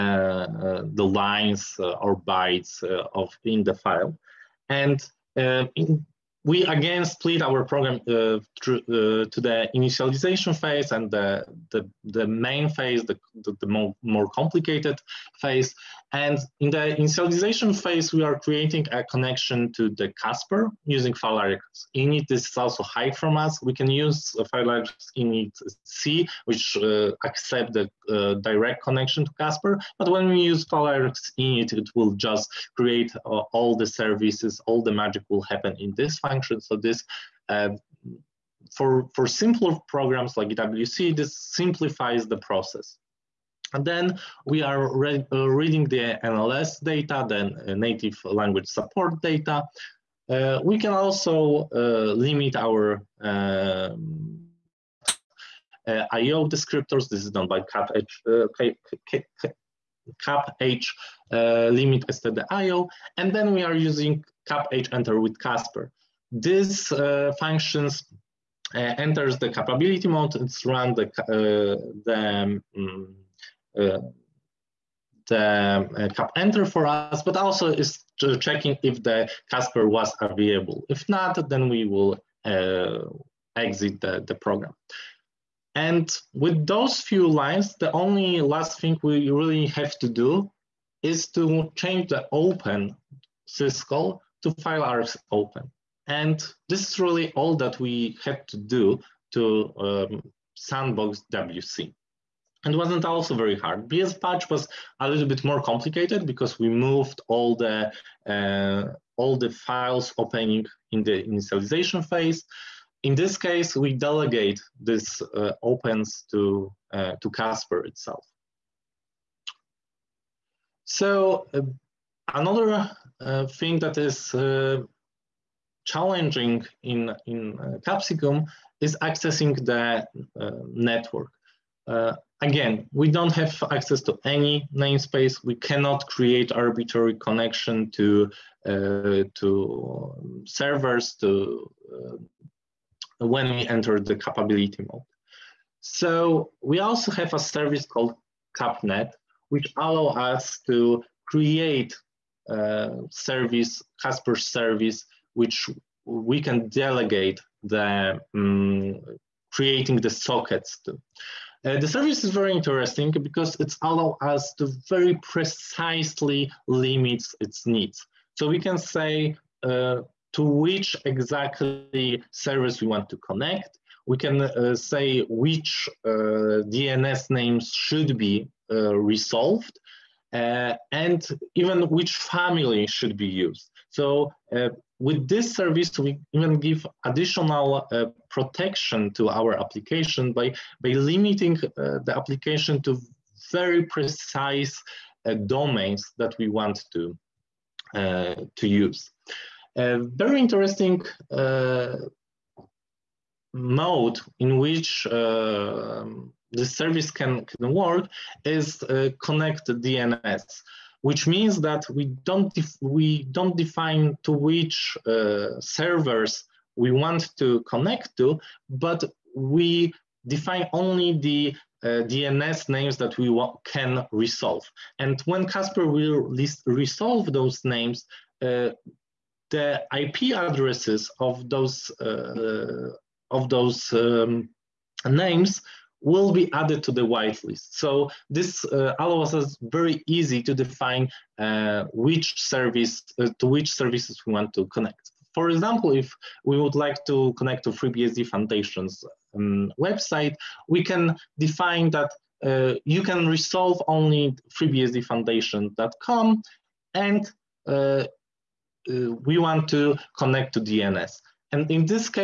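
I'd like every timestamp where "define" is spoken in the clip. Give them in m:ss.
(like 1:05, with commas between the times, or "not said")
3:33, 3:40, 4:00, 4:11.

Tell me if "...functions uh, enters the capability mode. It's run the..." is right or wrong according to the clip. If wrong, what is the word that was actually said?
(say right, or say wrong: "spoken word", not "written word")
right.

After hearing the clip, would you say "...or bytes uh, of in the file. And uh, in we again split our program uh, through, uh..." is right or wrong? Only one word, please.
right.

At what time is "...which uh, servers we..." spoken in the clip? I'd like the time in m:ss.
3:34.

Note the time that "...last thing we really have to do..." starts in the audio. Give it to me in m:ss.
1:28.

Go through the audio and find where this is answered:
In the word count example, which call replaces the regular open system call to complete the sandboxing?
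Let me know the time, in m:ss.
1:34.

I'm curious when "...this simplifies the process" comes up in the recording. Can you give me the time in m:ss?
0:41.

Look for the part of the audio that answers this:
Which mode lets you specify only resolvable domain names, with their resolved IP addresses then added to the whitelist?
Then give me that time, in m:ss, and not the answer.
3:29.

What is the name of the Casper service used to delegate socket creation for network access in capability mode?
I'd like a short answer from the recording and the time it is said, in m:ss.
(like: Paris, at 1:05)
CapNet, at 2:28.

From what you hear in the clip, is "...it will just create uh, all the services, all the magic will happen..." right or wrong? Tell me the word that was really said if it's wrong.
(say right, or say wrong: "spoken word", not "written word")
right.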